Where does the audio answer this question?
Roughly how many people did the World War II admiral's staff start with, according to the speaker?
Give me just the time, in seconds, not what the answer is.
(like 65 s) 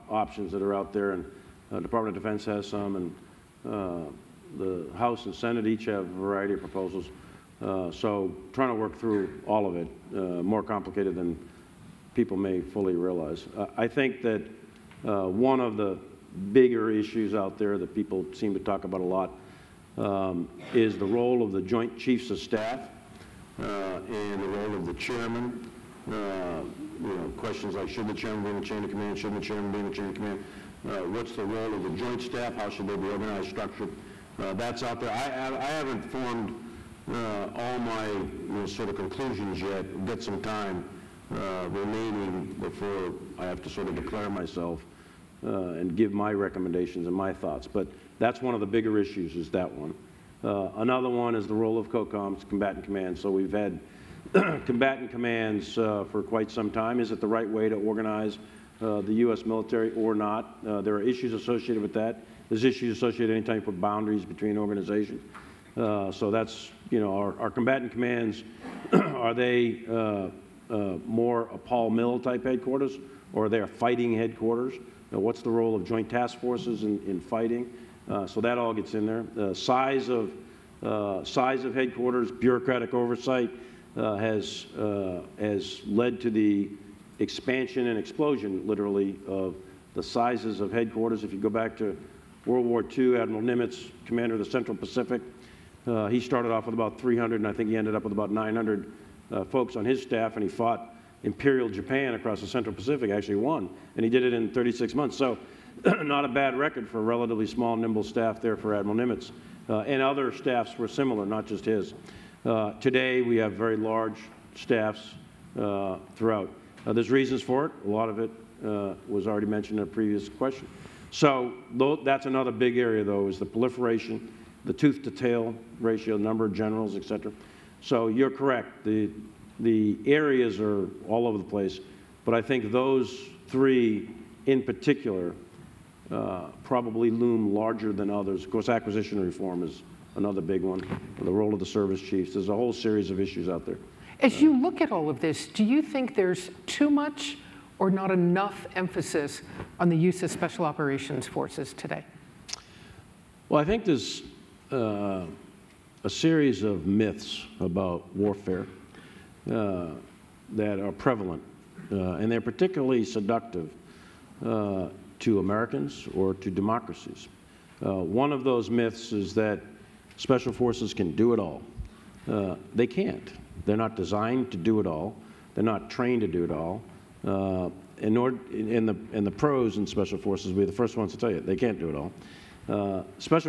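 96 s.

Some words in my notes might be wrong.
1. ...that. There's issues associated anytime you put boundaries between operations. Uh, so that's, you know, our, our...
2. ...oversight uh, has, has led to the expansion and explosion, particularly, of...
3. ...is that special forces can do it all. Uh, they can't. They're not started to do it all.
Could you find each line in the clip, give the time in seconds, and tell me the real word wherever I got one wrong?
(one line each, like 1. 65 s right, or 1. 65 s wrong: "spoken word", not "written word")
1. 61 s wrong: "organizations", not "operations"
2. 82 s wrong: "literally", not "particularly"
3. 169 s wrong: "designed", not "started".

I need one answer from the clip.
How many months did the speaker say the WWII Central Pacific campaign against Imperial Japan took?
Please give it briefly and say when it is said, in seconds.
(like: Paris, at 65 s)
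36, at 104 s.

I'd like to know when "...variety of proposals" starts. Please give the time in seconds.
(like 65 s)
6 s.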